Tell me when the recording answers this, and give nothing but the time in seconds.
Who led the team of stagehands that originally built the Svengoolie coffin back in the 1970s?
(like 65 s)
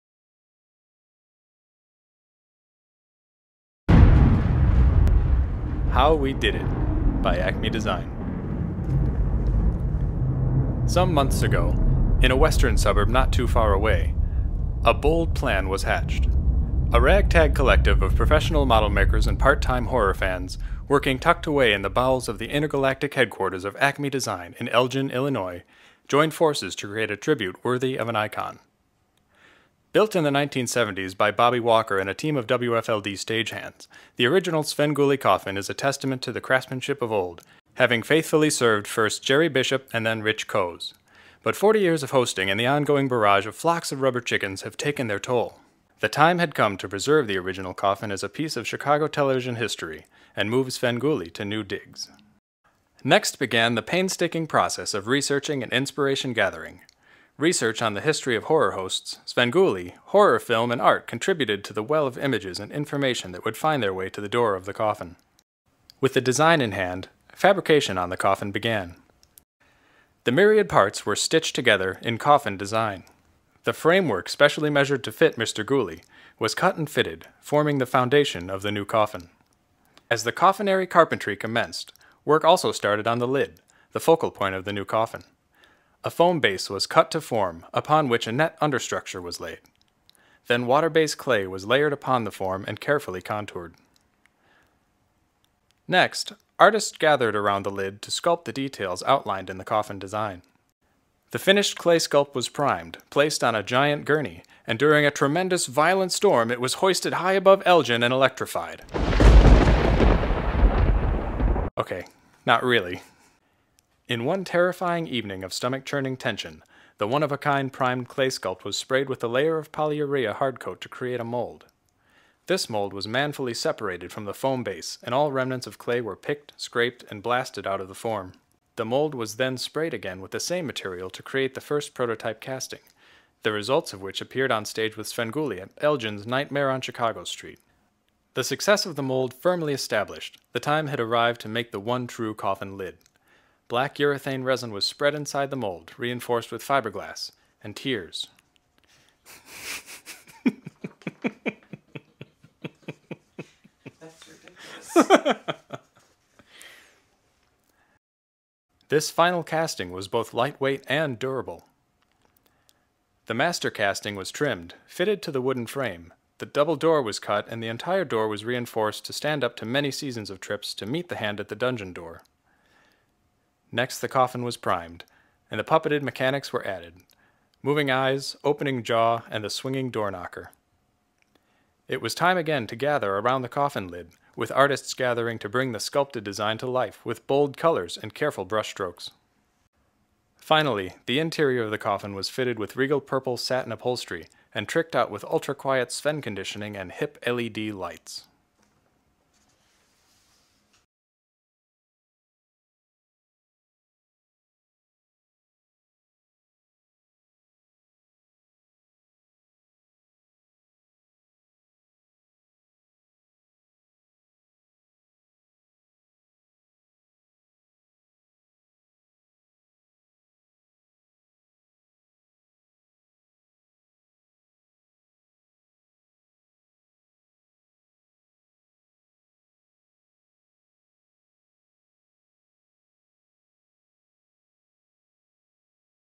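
31 s.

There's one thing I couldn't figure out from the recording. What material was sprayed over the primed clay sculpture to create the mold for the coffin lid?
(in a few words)
Polyurea hardcoat.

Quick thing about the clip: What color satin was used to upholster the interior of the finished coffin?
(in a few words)
Purple.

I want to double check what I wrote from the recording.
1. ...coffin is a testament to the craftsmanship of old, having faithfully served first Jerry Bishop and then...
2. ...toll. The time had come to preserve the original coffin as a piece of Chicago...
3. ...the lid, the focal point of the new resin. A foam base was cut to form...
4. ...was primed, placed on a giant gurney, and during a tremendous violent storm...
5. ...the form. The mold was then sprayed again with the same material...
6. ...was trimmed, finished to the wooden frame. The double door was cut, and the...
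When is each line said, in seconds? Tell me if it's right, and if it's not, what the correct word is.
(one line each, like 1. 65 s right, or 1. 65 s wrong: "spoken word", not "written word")
1. 35 s right
2. 45 s right
3. 83 s wrong: "coffin", not "resin"
4. 102 s right
5. 127 s right
6. 164 s wrong: "fitted", not "finished".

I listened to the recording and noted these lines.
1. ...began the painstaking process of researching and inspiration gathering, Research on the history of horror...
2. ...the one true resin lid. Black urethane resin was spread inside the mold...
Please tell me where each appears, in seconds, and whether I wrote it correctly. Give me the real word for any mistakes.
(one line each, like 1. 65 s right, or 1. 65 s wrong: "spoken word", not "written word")
1. 53 s right
2. 141 s wrong: "coffin", not "resin".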